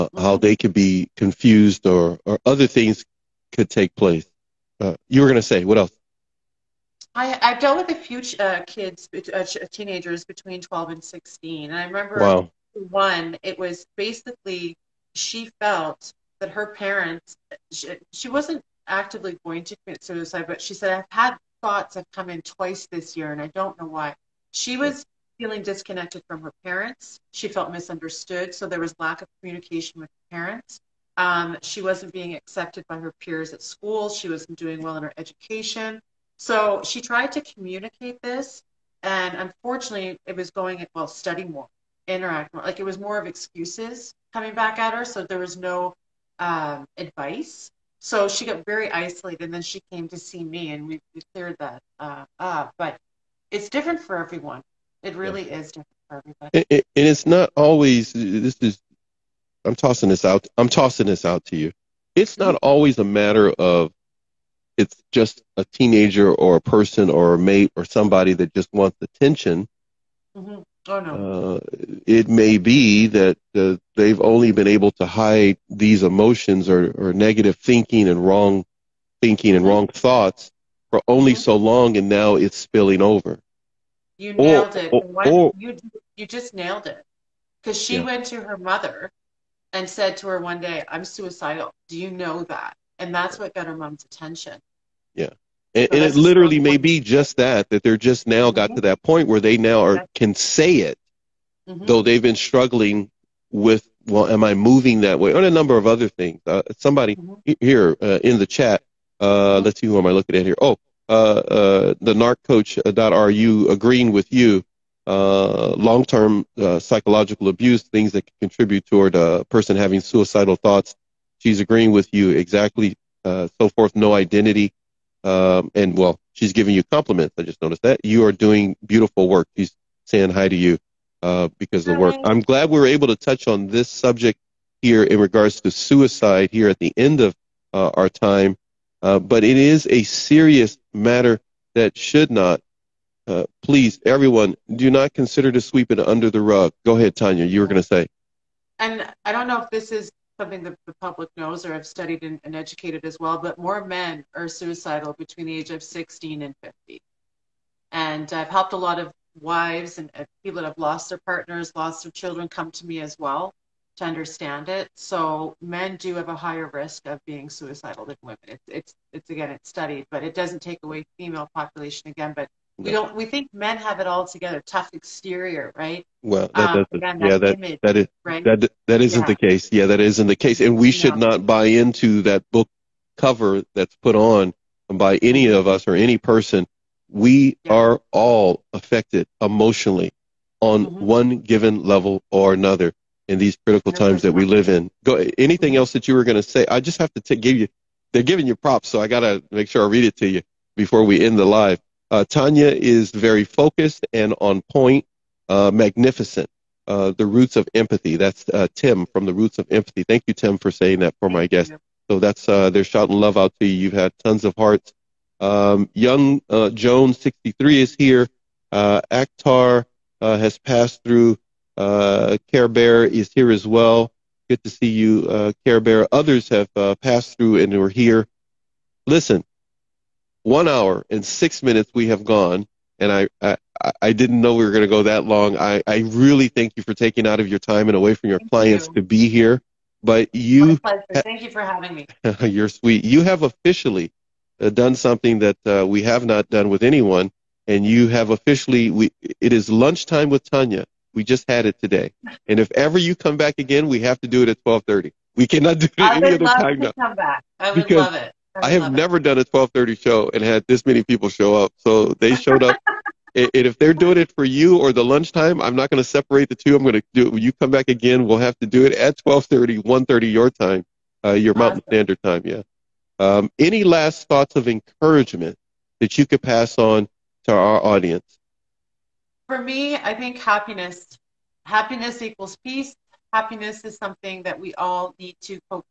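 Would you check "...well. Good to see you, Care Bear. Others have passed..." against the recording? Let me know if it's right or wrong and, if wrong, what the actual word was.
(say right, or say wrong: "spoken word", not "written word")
right.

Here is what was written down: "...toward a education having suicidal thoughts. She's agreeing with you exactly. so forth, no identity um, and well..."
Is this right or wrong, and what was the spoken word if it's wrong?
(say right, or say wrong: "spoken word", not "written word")
wrong: "person", not "education".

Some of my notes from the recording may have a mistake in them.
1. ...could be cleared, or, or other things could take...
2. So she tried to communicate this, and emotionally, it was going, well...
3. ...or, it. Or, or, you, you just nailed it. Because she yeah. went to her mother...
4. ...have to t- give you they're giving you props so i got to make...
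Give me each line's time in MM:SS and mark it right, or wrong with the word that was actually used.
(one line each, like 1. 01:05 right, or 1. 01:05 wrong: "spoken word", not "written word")
1. 00:00 wrong: "confused", not "cleared"
2. 00:36 wrong: "unfortunately", not "emotionally"
3. 01:24 right
4. 03:16 right.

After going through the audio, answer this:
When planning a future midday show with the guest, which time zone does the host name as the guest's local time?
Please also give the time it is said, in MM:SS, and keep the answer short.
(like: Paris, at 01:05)
Mountain Standard Time, at 04:31.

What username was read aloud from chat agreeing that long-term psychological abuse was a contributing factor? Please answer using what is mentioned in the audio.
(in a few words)
narccoach.ru.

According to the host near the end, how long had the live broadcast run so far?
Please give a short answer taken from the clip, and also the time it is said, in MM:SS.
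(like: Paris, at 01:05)
1 hour and 6 minutes, at 03:50.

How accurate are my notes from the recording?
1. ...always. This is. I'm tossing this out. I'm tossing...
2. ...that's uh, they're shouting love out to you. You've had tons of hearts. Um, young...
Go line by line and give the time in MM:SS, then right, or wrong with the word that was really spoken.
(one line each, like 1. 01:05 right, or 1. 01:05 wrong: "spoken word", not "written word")
1. 00:57 right
2. 03:32 right.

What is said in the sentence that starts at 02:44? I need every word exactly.
So men do have a higher risk of being suicidal than women.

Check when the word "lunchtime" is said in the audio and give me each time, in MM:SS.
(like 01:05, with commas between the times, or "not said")
04:09, 04:25.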